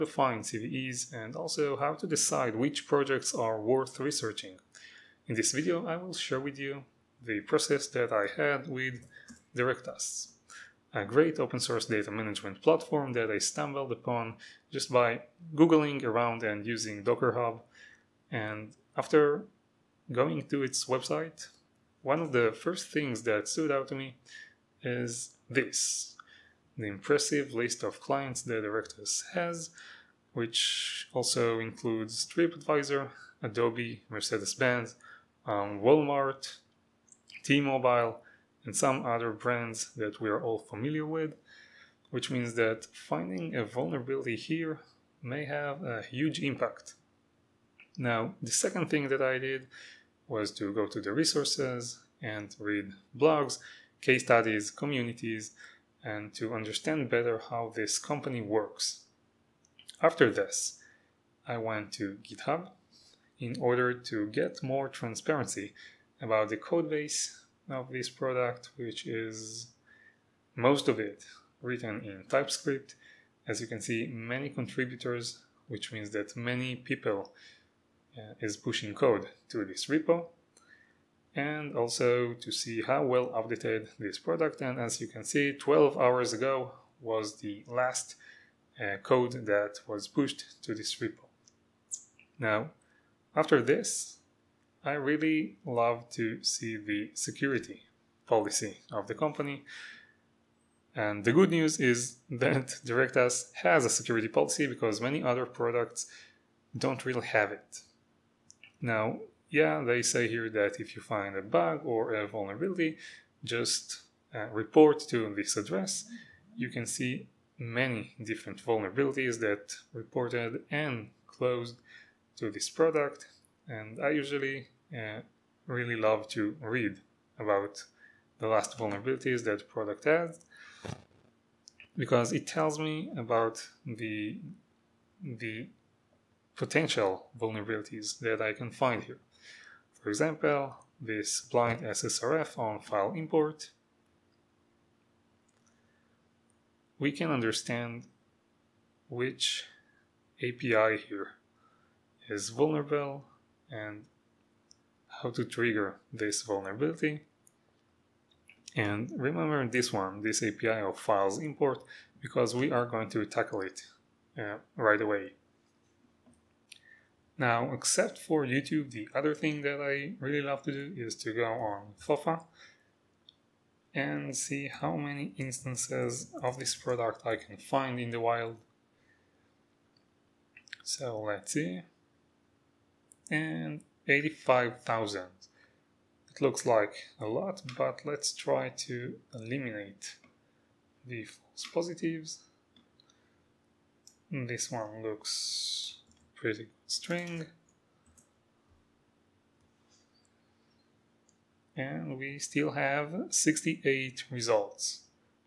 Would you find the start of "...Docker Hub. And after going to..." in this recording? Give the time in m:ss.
0:17.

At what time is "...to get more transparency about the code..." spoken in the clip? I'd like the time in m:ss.
1:03.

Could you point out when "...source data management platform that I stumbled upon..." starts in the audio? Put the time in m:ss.
0:11.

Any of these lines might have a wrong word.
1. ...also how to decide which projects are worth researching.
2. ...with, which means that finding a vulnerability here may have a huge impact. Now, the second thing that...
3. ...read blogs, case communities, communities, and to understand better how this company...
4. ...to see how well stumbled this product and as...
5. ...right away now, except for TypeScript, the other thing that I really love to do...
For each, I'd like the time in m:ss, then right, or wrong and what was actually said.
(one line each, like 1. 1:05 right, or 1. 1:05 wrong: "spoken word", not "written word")
1. 0:01 right
2. 0:41 right
3. 0:52 wrong: "studies", not "communities"
4. 1:22 wrong: "updated", not "stumbled"
5. 2:44 wrong: "YouTube", not "TypeScript".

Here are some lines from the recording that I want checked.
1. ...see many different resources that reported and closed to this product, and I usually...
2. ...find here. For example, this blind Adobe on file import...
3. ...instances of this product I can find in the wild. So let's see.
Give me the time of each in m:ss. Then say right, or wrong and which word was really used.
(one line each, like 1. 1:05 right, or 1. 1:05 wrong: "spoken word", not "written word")
1. 1:56 wrong: "vulnerabilities", not "resources"
2. 2:18 wrong: "SSRF", not "Adobe"
3. 2:55 right.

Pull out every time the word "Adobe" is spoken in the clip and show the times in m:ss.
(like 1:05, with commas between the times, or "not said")
0:33.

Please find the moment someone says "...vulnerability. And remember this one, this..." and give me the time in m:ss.
2:36.